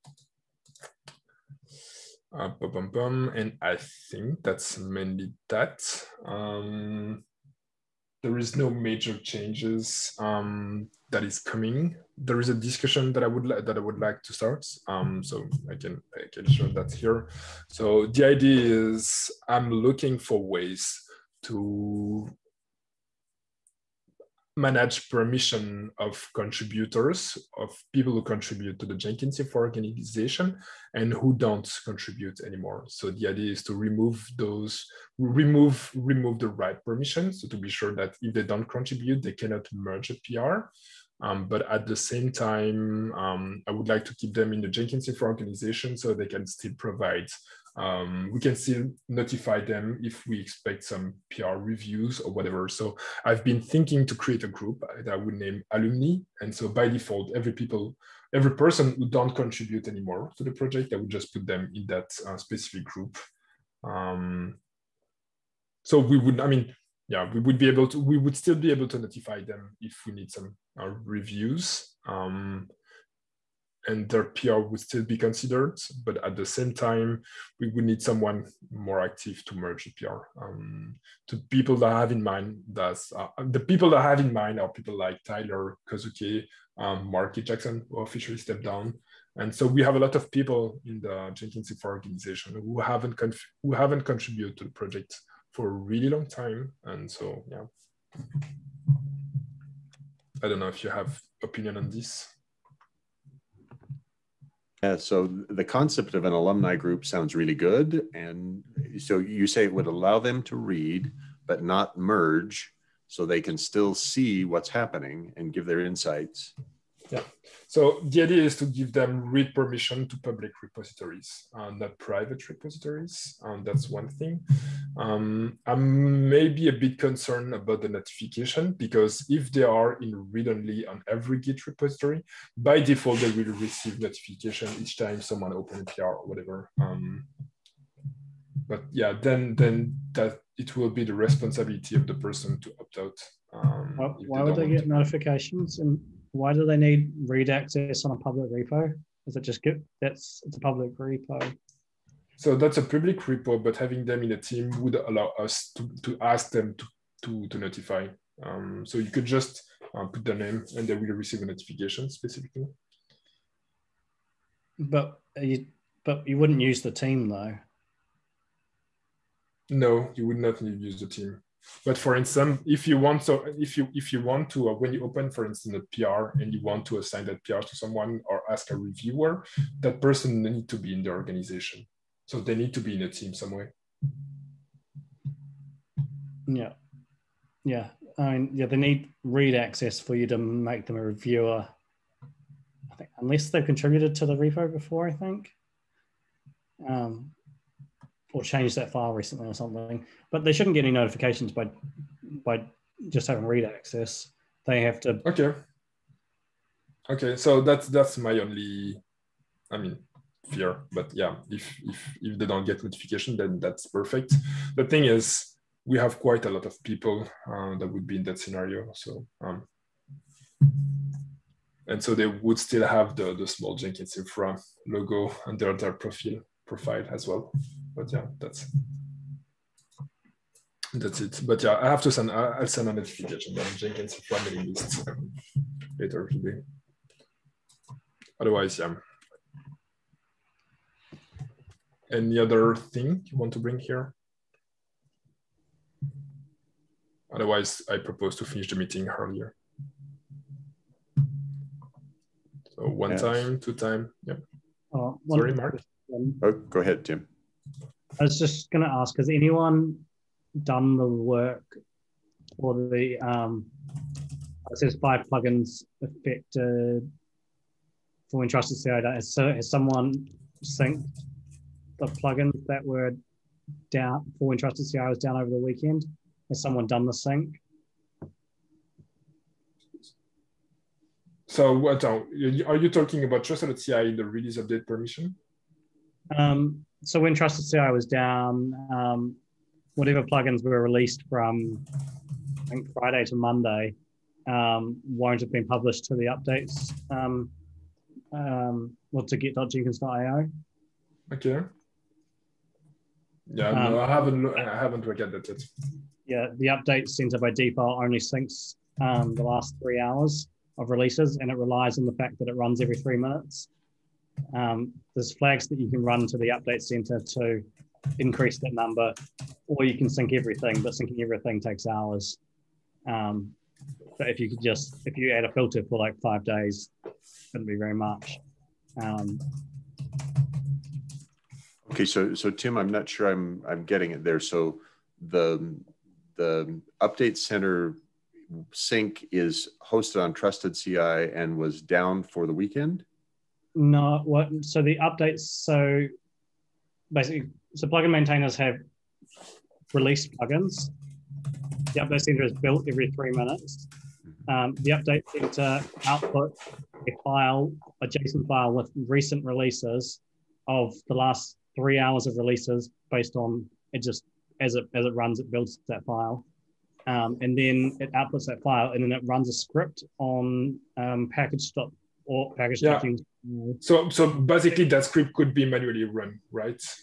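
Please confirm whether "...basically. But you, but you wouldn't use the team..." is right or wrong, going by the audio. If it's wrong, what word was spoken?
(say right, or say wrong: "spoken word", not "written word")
wrong: "specifically", not "basically".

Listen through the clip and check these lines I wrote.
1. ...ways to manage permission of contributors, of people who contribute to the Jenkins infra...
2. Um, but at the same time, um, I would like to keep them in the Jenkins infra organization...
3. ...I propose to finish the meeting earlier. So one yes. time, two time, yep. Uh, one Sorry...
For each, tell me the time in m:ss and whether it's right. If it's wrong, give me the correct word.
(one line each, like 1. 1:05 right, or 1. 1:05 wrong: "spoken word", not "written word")
1. 0:20 right
2. 0:41 right
3. 4:07 right.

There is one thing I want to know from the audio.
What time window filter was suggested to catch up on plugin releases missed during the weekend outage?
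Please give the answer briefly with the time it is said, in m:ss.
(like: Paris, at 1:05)
5 days, at 5:26.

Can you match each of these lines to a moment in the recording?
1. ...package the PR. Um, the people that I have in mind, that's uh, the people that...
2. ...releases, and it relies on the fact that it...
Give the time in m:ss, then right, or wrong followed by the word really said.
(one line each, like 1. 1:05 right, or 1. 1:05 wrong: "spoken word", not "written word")
1. 1:19 wrong: "merge", not "package"
2. 5:10 right.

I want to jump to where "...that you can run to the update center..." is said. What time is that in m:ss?
5:15.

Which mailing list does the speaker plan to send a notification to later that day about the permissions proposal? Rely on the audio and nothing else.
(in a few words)
Jenkins family list.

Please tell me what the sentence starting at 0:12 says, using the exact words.
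There is a discussion that I would that I would like to start.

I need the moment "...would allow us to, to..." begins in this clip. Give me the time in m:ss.
2:34.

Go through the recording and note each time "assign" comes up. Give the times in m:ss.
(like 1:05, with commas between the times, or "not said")
2:56.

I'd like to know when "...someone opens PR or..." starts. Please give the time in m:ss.
2:15.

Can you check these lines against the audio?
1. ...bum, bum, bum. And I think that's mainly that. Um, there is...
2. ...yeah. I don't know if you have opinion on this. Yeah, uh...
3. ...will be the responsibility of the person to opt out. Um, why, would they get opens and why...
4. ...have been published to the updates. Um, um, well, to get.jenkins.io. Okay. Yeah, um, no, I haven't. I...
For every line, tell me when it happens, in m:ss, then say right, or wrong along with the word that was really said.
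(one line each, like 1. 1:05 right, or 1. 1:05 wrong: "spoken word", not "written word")
1. 0:02 right
2. 1:37 right
3. 2:20 wrong: "notifications", not "opens"
4. 4:55 right.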